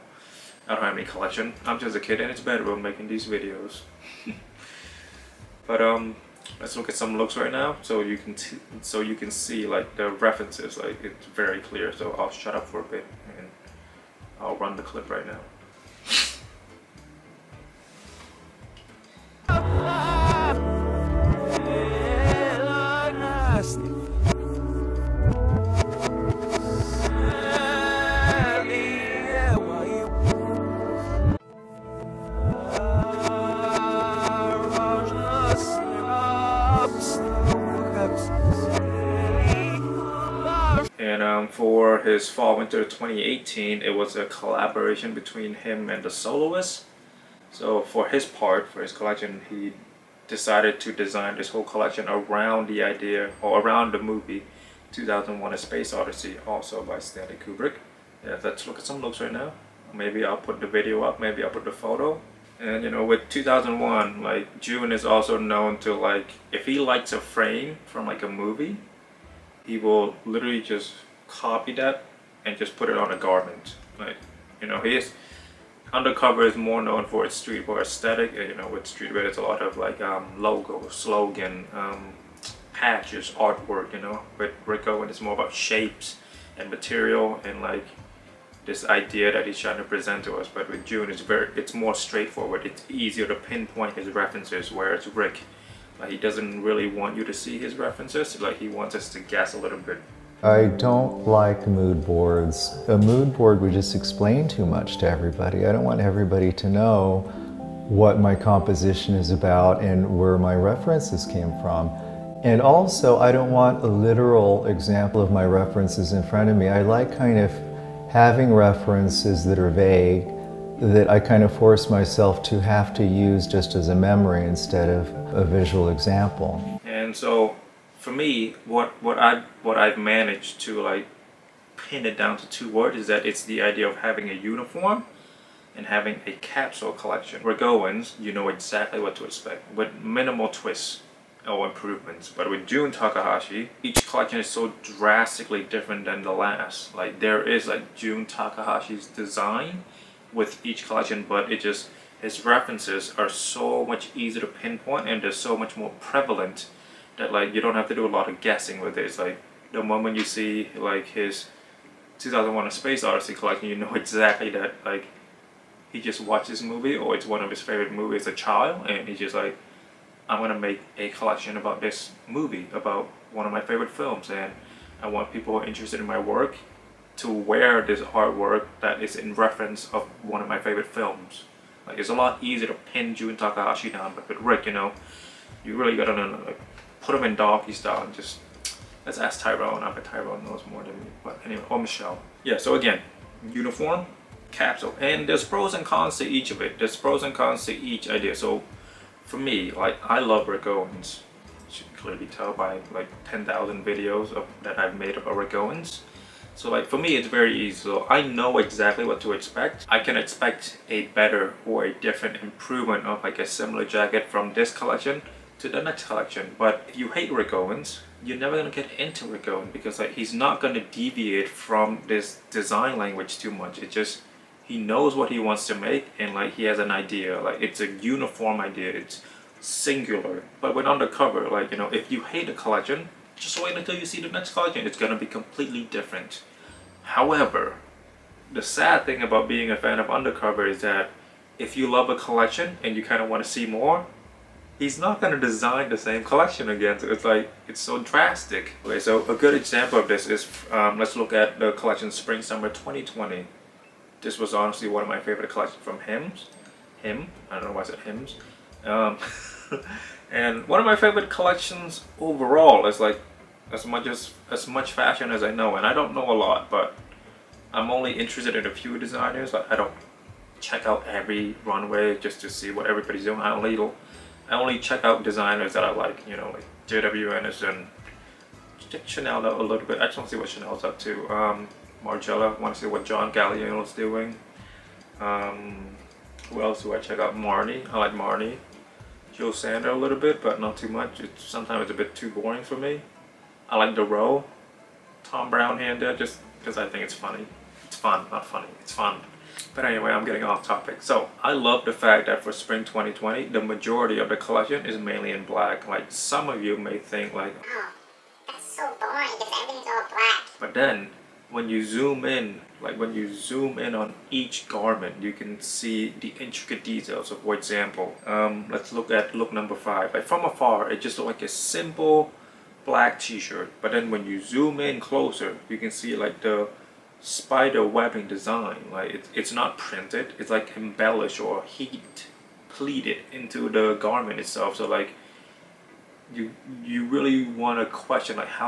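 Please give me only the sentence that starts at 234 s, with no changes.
It's going to be completely different.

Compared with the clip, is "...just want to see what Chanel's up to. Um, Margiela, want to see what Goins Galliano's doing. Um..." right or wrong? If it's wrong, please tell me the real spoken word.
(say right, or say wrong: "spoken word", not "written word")
wrong: "John", not "Goins".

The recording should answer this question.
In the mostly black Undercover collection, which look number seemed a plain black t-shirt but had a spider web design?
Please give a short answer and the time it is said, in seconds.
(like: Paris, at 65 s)
5, at 319 s.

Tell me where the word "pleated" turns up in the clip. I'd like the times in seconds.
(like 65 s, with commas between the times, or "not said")
332 s.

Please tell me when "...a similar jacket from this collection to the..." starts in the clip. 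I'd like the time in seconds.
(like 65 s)
213 s.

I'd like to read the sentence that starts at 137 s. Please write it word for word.
Where Goins, you know exactly what to expect with minimal twists or improvements.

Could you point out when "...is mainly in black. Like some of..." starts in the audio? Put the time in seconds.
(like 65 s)
304 s.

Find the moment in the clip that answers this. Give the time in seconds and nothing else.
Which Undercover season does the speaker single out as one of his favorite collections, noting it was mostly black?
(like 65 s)
252 s.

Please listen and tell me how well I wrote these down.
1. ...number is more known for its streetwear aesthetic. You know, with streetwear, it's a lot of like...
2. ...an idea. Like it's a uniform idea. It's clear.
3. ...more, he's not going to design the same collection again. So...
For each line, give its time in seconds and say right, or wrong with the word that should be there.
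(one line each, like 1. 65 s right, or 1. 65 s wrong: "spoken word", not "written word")
1. 75 s wrong: "undercover", not "number"
2. 226 s wrong: "singular", not "clear"
3. 243 s right.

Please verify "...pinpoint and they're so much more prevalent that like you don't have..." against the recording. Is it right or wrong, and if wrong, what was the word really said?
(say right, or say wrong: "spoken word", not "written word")
right.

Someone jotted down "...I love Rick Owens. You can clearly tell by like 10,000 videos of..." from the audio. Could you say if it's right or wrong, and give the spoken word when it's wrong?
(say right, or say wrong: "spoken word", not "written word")
right.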